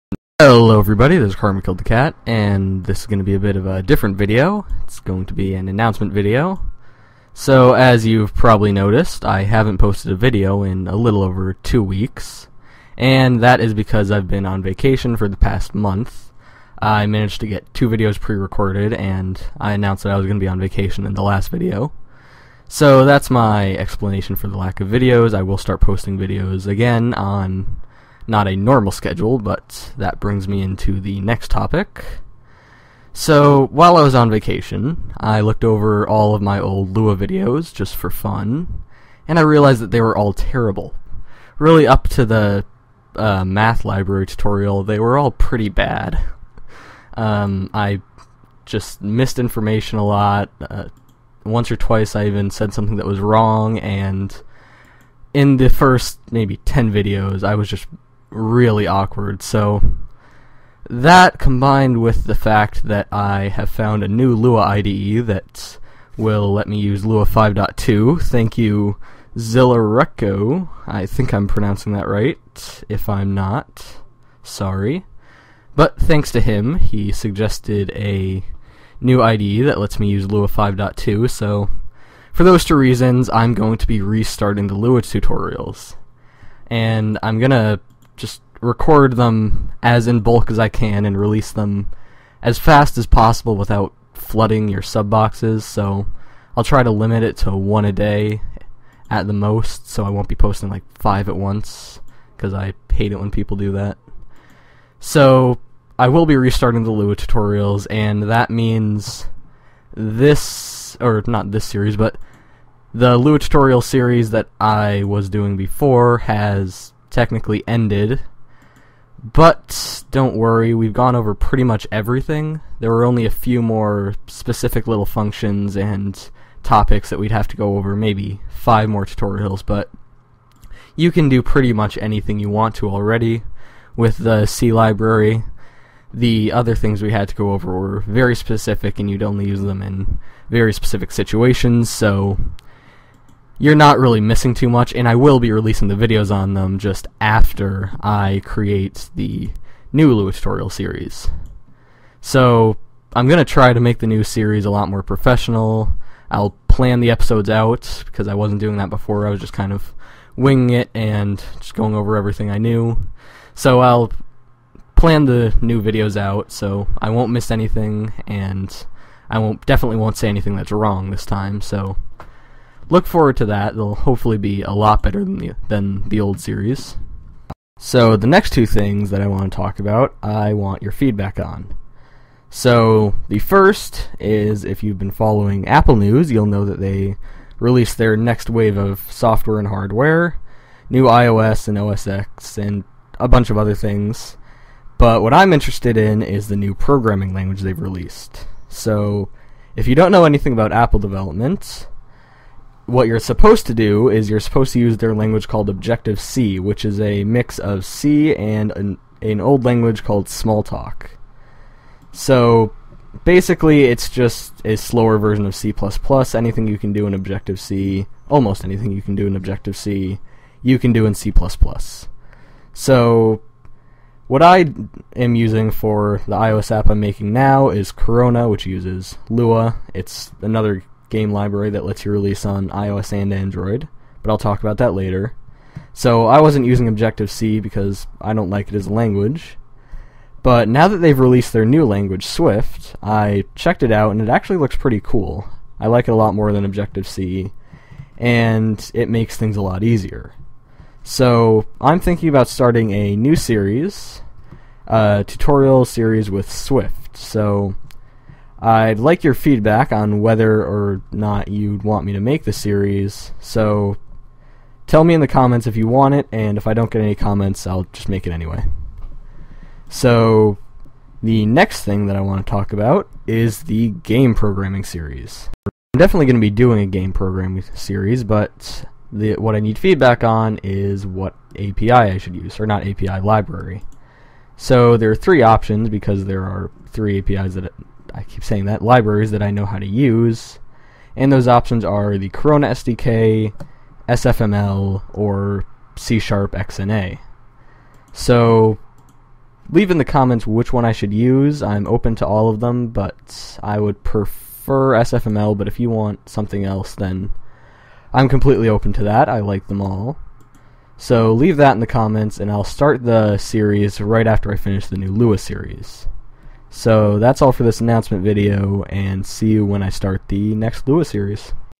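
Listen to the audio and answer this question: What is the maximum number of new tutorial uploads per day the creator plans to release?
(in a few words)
1.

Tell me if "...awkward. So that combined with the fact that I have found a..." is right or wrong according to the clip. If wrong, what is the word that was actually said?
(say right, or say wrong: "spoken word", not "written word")
right.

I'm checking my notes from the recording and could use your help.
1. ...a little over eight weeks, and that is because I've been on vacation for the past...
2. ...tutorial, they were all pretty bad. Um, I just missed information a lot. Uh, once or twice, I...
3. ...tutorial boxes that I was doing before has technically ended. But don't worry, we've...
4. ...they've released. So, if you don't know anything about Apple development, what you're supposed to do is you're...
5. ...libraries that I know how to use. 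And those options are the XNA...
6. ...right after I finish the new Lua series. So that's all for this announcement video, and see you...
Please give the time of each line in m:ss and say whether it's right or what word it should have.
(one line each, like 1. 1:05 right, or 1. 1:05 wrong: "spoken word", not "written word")
1. 0:10 wrong: "two", not "eight"
2. 0:44 right
3. 1:53 wrong: "series", not "boxes"
4. 3:17 right
5. 4:48 wrong: "Corona", not "XNA"
6. 5:13 right.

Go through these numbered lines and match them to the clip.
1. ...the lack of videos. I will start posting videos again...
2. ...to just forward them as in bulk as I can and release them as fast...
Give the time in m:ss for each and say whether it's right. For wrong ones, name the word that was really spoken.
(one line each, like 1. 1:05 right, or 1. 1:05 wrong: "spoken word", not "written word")
1. 0:24 right
2. 1:27 wrong: "record", not "forward".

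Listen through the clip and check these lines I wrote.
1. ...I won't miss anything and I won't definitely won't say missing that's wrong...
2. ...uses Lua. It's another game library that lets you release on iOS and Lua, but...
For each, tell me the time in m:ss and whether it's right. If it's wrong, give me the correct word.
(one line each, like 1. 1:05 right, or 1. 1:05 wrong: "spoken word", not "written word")
1. 2:46 wrong: "anything", not "missing"
2. 3:48 wrong: "Android", not "Lua".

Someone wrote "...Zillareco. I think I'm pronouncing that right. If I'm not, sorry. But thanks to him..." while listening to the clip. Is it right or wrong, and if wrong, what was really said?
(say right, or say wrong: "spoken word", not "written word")
right.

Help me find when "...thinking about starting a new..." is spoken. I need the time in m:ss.
4:11.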